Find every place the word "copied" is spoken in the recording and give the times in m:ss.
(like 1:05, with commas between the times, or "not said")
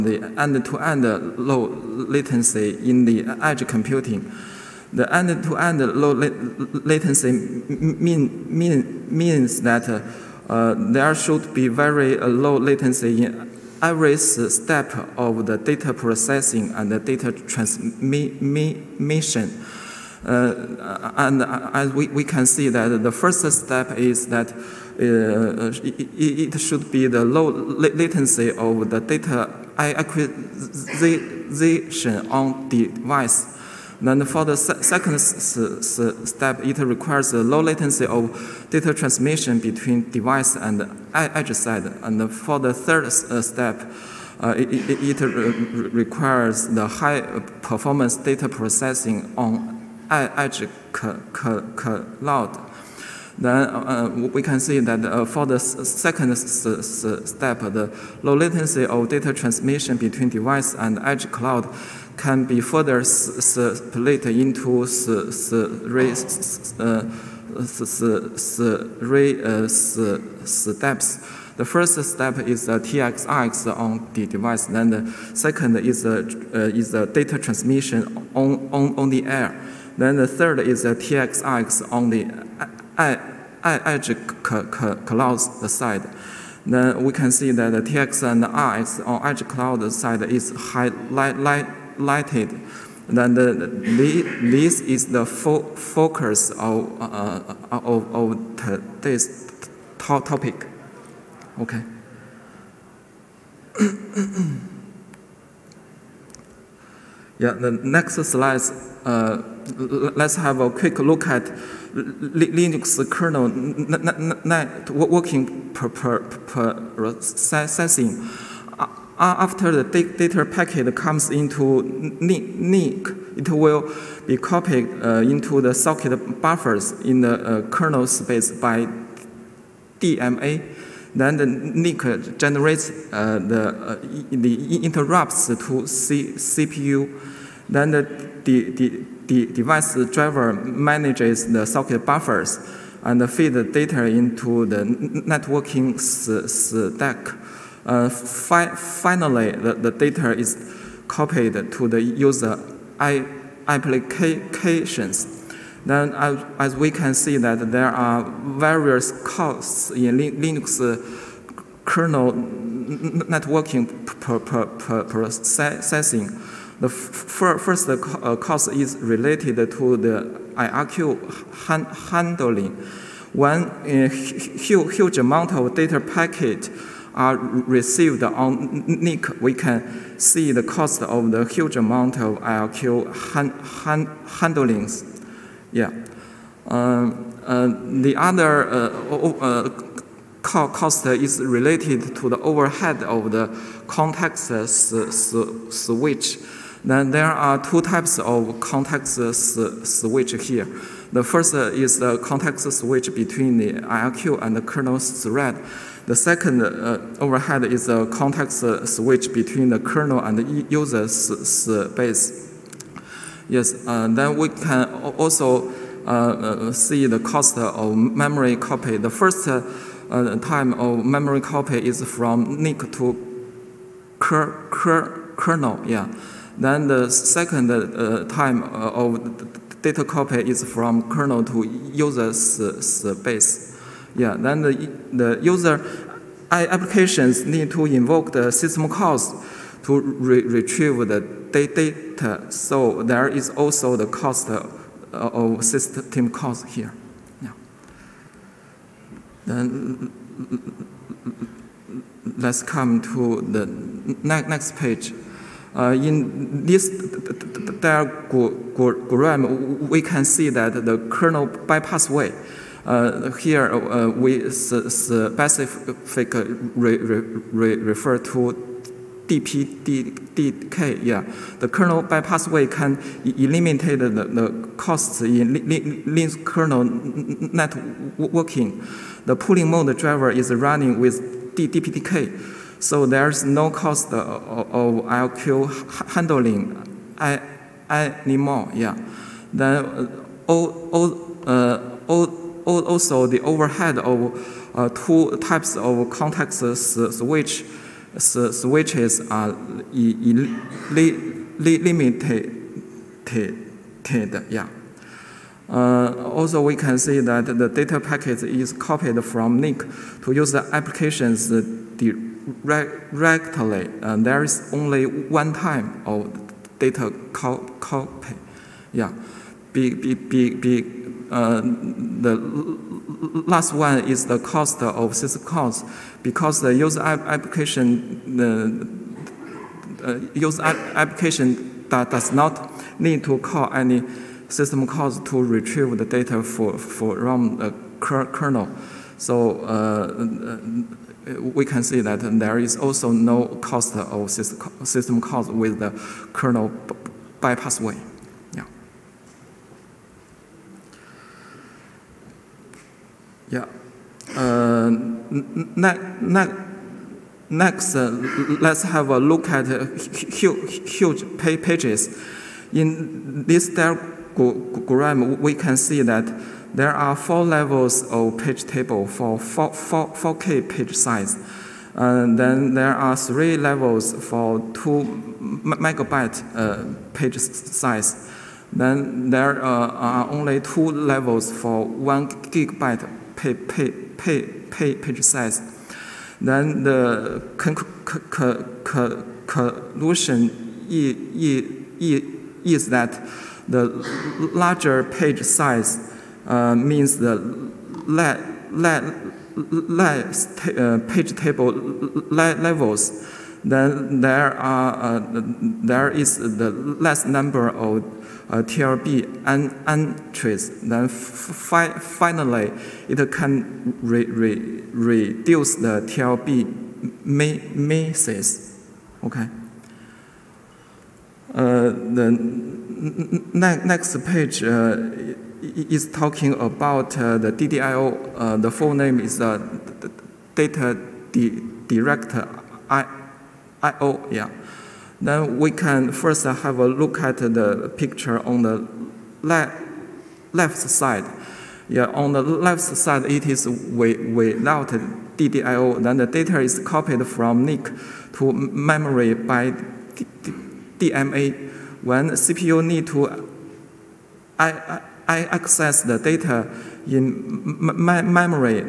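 2:04, 2:31, 5:08, 7:26.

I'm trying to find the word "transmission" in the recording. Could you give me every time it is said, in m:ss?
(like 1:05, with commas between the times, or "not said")
0:17, 0:38, 0:59, 1:17.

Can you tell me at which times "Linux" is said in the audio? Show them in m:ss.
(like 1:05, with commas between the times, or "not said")
1:51, 2:40, 4:35.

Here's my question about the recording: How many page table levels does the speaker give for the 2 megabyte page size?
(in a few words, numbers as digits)
3.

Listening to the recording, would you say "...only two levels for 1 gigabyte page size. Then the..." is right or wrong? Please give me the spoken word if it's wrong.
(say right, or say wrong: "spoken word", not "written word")
right.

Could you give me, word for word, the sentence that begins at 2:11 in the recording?
Then the NIC generates uh, the, uh, the interrupts to C CPU.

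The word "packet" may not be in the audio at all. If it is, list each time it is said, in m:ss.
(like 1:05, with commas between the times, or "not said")
2:00, 2:55, 5:07.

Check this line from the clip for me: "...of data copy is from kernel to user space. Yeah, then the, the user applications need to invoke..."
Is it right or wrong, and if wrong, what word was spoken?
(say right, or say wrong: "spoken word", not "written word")
right.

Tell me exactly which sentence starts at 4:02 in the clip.
So there is also the cost uh, of system calls here.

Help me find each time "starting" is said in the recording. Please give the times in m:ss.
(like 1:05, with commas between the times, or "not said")
not said.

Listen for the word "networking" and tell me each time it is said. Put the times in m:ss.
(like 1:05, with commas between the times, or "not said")
1:53, 2:25, 2:42, 4:36.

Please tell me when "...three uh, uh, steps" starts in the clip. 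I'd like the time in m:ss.
1:08.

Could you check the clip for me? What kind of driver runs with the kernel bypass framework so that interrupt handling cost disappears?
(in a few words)
Polling mode driver.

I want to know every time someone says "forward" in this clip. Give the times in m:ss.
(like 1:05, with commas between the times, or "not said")
not said.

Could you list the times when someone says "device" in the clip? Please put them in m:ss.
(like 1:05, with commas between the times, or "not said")
0:32, 0:40, 1:00, 1:14, 2:19.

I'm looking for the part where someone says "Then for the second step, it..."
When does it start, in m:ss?
0:34.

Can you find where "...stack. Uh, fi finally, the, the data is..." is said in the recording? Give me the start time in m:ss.
2:25.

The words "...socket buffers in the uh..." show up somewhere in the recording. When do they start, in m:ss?
2:05.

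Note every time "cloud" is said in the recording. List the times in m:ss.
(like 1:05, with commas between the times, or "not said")
0:50, 1:01, 1:25, 1:29.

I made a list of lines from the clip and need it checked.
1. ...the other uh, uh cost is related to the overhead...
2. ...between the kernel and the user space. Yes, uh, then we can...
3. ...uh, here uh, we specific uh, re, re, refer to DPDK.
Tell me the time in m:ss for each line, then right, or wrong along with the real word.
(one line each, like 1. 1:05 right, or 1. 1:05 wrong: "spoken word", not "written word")
1. 3:08 right
2. 3:29 right
3. 4:22 right.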